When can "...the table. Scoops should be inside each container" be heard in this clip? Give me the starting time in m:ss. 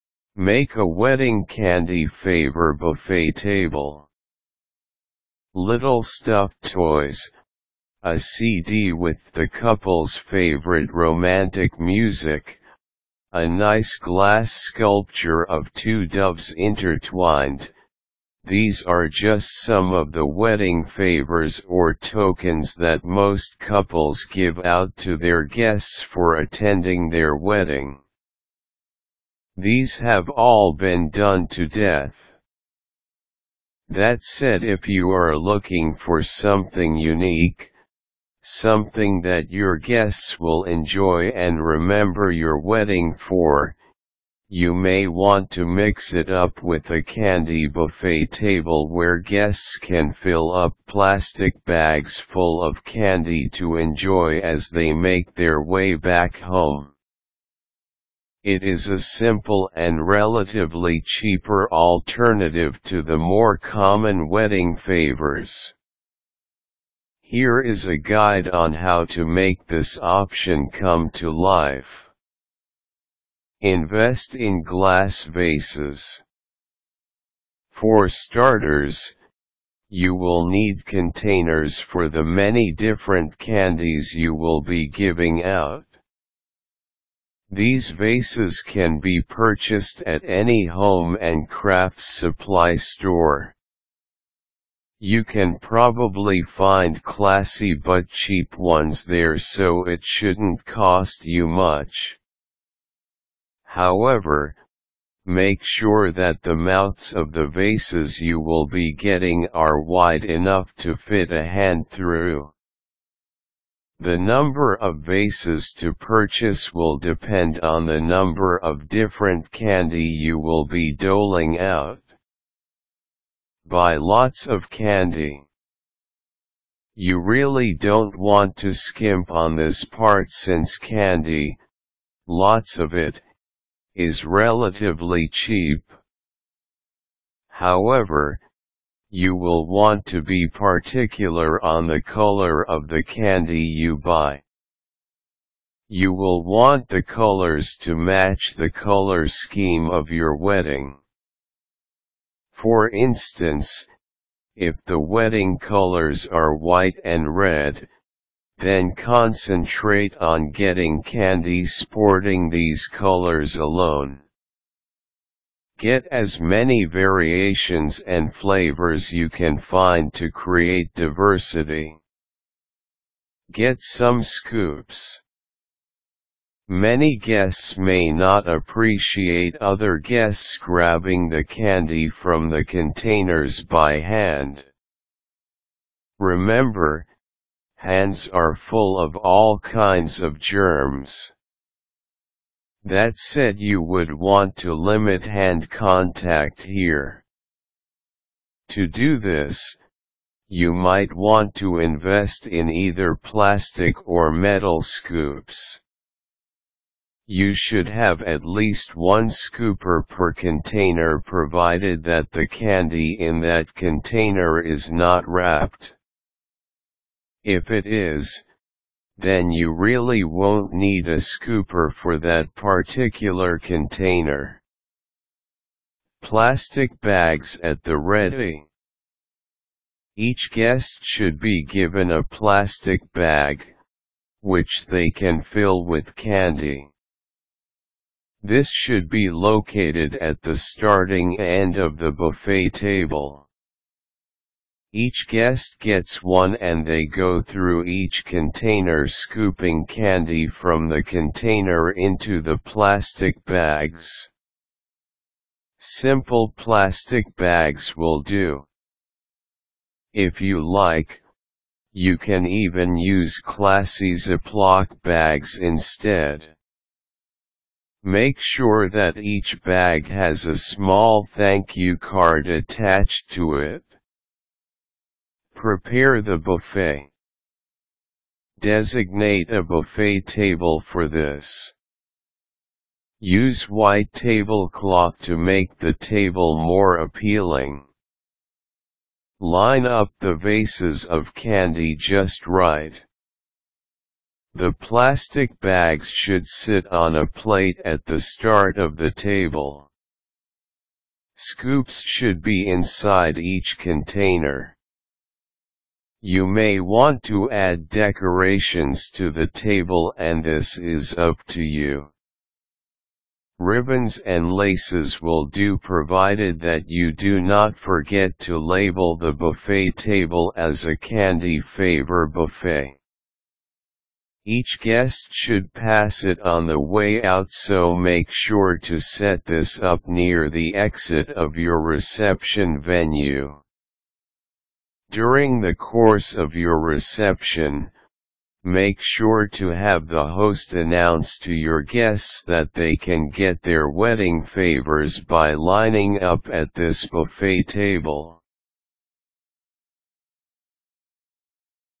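4:58.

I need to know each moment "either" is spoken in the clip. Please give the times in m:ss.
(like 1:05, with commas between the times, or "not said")
3:22.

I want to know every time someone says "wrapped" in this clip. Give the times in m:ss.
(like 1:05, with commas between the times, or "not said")
3:35.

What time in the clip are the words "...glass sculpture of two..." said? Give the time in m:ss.
0:13.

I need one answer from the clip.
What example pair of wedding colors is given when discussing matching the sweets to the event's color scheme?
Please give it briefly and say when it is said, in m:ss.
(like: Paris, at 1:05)
White and red, at 2:36.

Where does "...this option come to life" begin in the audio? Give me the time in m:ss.
1:09.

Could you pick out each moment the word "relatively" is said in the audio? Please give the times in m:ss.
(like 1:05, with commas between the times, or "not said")
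1:00, 2:14.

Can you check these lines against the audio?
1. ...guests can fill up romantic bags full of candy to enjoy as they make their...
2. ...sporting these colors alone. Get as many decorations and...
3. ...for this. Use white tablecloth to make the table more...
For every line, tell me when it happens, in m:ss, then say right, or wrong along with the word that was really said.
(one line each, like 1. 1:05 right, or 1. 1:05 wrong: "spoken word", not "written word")
1. 0:49 wrong: "plastic", not "romantic"
2. 2:41 wrong: "variations", not "decorations"
3. 4:40 right.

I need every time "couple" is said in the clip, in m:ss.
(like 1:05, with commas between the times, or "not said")
0:09, 0:23.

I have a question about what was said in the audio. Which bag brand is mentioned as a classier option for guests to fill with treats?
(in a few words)
Ziploc.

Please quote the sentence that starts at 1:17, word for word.
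For starters, you will need containers for the many different candies you will be giving out.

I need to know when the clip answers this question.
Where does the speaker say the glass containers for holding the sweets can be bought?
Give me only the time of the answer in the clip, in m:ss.
1:30.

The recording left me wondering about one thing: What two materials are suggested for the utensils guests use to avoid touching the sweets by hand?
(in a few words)
Plastic or metal.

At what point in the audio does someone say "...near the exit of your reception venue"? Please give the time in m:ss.
5:30.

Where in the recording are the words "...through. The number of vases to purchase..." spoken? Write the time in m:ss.
1:51.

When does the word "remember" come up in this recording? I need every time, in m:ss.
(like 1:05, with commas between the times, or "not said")
0:41, 3:06.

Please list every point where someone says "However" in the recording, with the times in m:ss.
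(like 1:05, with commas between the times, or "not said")
1:43, 2:17.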